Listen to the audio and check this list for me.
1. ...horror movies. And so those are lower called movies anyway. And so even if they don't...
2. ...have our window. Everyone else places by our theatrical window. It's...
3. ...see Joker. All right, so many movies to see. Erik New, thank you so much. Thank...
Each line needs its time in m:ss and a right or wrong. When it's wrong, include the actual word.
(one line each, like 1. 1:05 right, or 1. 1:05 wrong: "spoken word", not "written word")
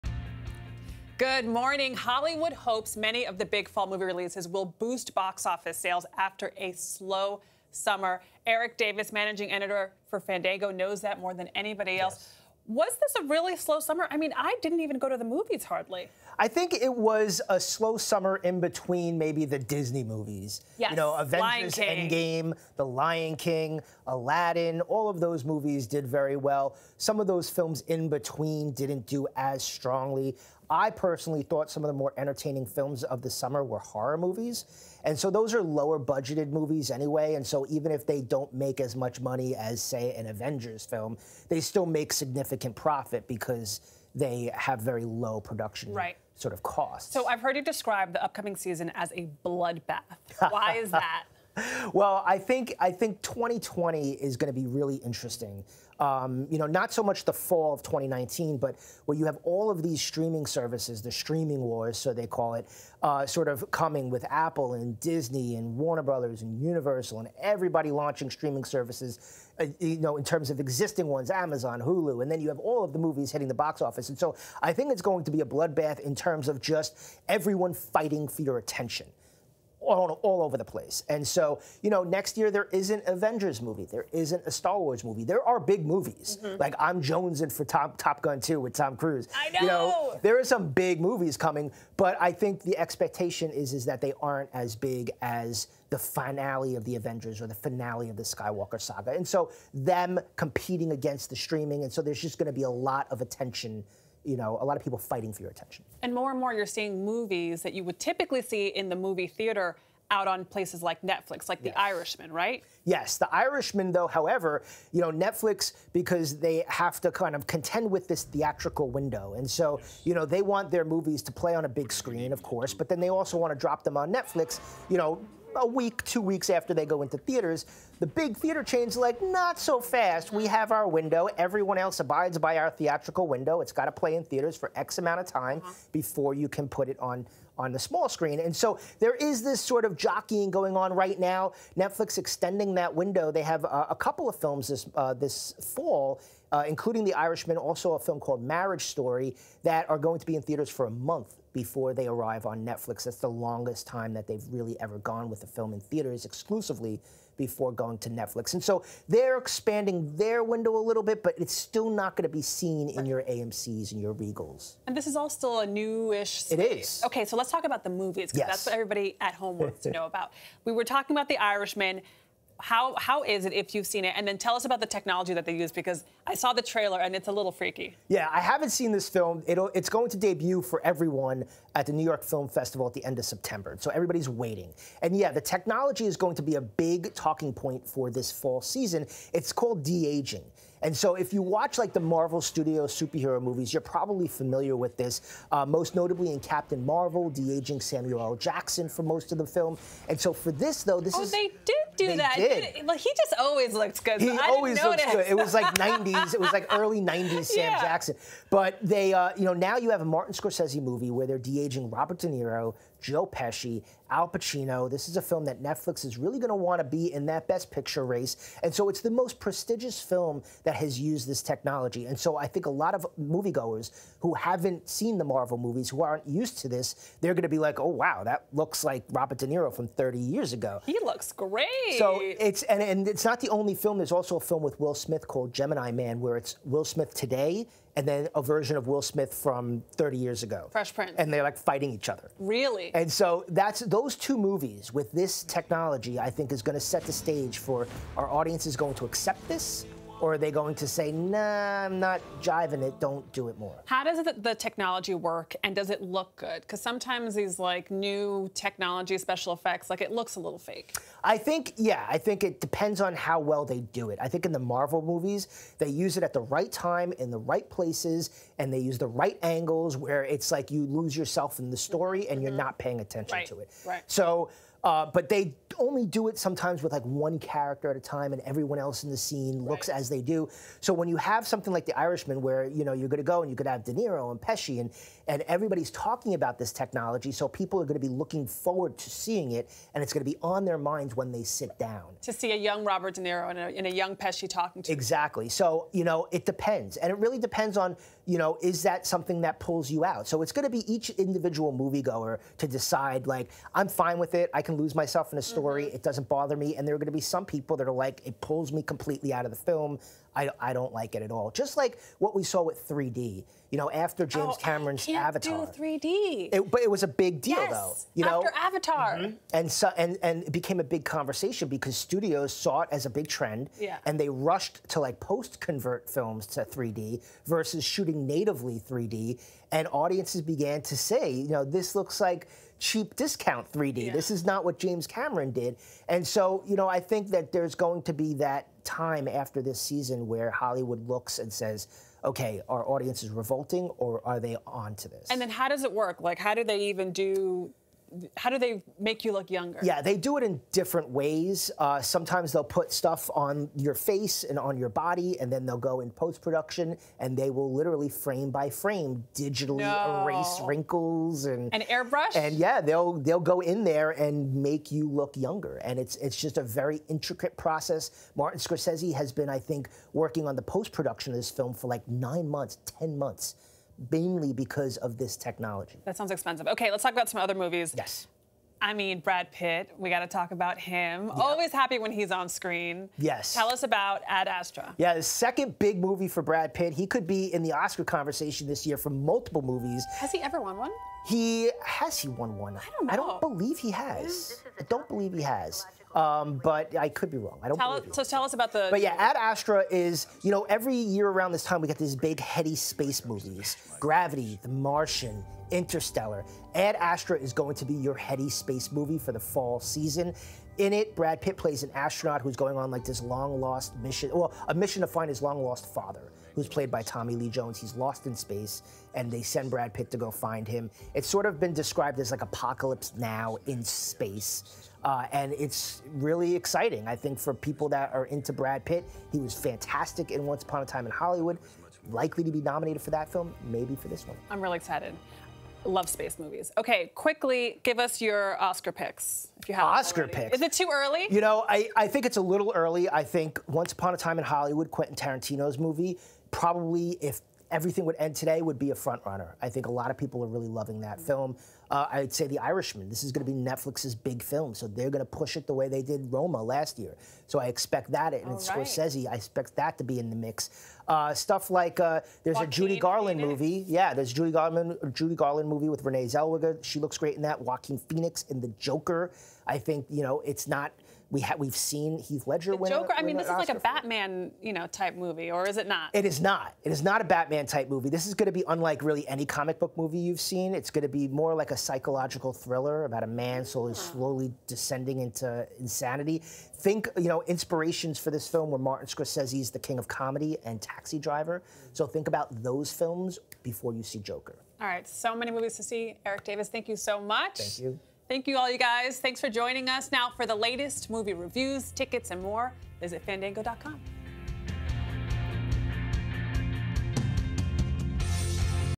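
1. 0:33 wrong: "budgeted", not "called"
2. 2:10 wrong: "abides", not "places"
3. 8:14 wrong: "Davis", not "New".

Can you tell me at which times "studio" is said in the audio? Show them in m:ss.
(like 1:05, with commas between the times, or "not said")
3:12, 5:21.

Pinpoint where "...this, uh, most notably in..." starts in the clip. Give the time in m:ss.
3:14.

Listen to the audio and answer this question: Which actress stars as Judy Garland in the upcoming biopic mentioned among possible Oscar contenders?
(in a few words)
Renee Zellweger.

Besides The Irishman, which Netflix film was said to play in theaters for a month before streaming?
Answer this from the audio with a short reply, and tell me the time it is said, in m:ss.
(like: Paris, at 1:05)
Marriage Story, at 2:28.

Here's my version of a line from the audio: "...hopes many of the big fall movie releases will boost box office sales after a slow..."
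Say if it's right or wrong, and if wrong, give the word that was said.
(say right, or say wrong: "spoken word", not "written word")
right.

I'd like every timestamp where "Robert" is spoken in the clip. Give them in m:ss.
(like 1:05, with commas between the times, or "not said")
3:31, 3:49, 4:52.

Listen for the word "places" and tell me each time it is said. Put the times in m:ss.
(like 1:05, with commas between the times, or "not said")
1:20, 1:50, 4:27.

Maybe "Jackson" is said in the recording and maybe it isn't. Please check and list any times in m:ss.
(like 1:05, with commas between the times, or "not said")
3:18, 3:27.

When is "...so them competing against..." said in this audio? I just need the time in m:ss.
1:39.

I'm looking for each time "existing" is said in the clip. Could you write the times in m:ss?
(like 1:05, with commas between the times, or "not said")
1:10.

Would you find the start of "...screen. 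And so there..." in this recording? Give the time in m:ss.
2:18.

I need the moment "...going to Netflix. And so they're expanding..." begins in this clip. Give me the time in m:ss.
2:37.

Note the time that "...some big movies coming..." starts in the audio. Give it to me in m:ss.
1:30.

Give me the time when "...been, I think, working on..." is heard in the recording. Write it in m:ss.
6:09.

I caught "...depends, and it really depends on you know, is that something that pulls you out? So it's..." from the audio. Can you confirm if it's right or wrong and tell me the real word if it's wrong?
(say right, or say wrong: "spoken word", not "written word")
right.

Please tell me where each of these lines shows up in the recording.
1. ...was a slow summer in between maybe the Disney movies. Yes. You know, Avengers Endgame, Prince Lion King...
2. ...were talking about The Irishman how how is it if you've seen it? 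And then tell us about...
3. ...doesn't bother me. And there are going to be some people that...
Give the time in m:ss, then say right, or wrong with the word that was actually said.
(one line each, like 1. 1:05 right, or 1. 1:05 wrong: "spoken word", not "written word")
1. 0:16 wrong: "The", not "Prince"
2. 2:50 right
3. 5:06 right.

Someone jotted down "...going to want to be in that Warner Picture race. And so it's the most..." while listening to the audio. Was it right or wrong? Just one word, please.
wrong.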